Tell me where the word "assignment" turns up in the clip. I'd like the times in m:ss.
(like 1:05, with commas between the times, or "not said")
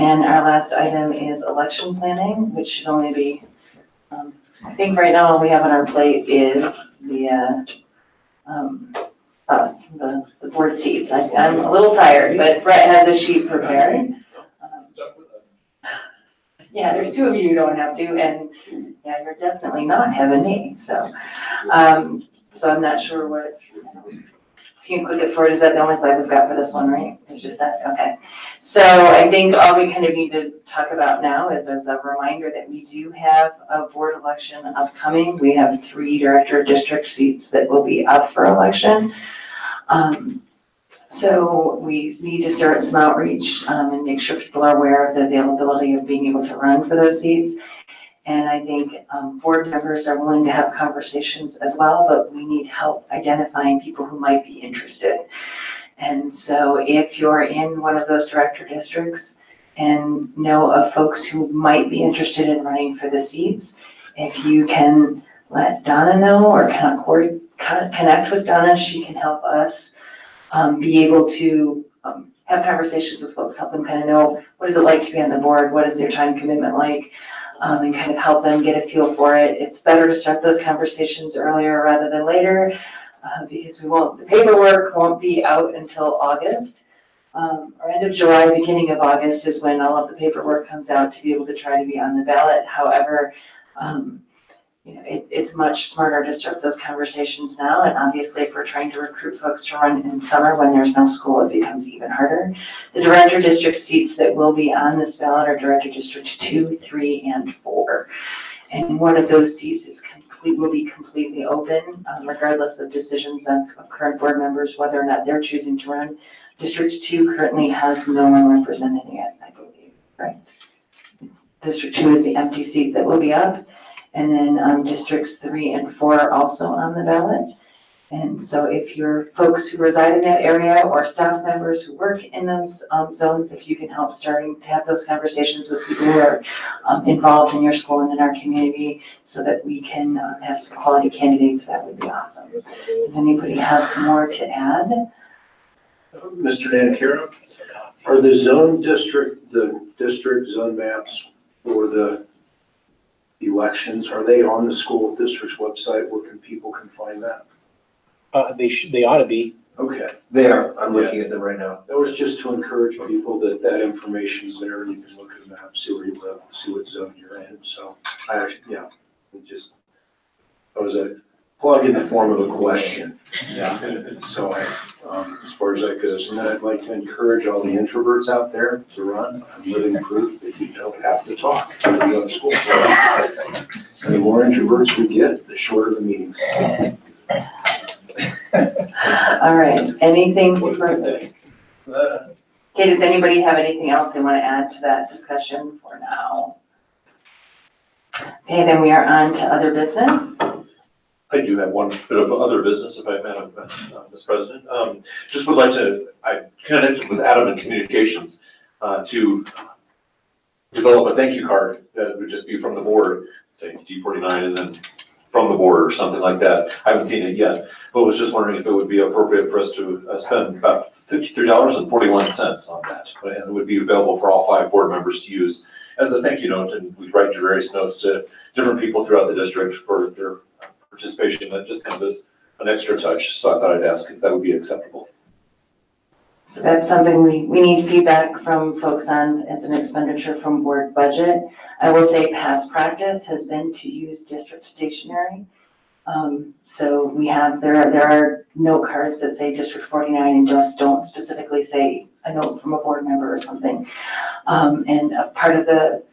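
not said.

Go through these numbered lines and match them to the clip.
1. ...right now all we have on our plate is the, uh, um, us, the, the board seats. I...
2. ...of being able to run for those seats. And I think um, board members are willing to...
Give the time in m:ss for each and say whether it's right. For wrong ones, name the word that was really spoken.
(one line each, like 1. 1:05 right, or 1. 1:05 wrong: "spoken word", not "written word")
1. 0:04 right
2. 0:45 right.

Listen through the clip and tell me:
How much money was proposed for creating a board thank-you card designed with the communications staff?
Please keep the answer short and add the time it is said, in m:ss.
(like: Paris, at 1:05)
$53.41, at 3:41.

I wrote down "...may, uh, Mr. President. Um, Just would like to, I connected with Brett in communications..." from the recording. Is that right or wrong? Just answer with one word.
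wrong.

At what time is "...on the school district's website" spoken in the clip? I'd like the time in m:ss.
2:34.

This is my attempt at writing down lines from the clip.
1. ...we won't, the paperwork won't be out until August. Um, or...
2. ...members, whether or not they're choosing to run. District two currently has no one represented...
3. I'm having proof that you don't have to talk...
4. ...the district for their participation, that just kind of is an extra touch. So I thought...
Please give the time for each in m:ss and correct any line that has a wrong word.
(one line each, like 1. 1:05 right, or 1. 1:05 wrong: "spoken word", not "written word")
1. 1:23 right
2. 1:54 right
3. 2:59 wrong: "living", not "having"
4. 3:49 right.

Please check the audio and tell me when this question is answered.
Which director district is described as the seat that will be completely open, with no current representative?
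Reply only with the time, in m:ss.
2:01.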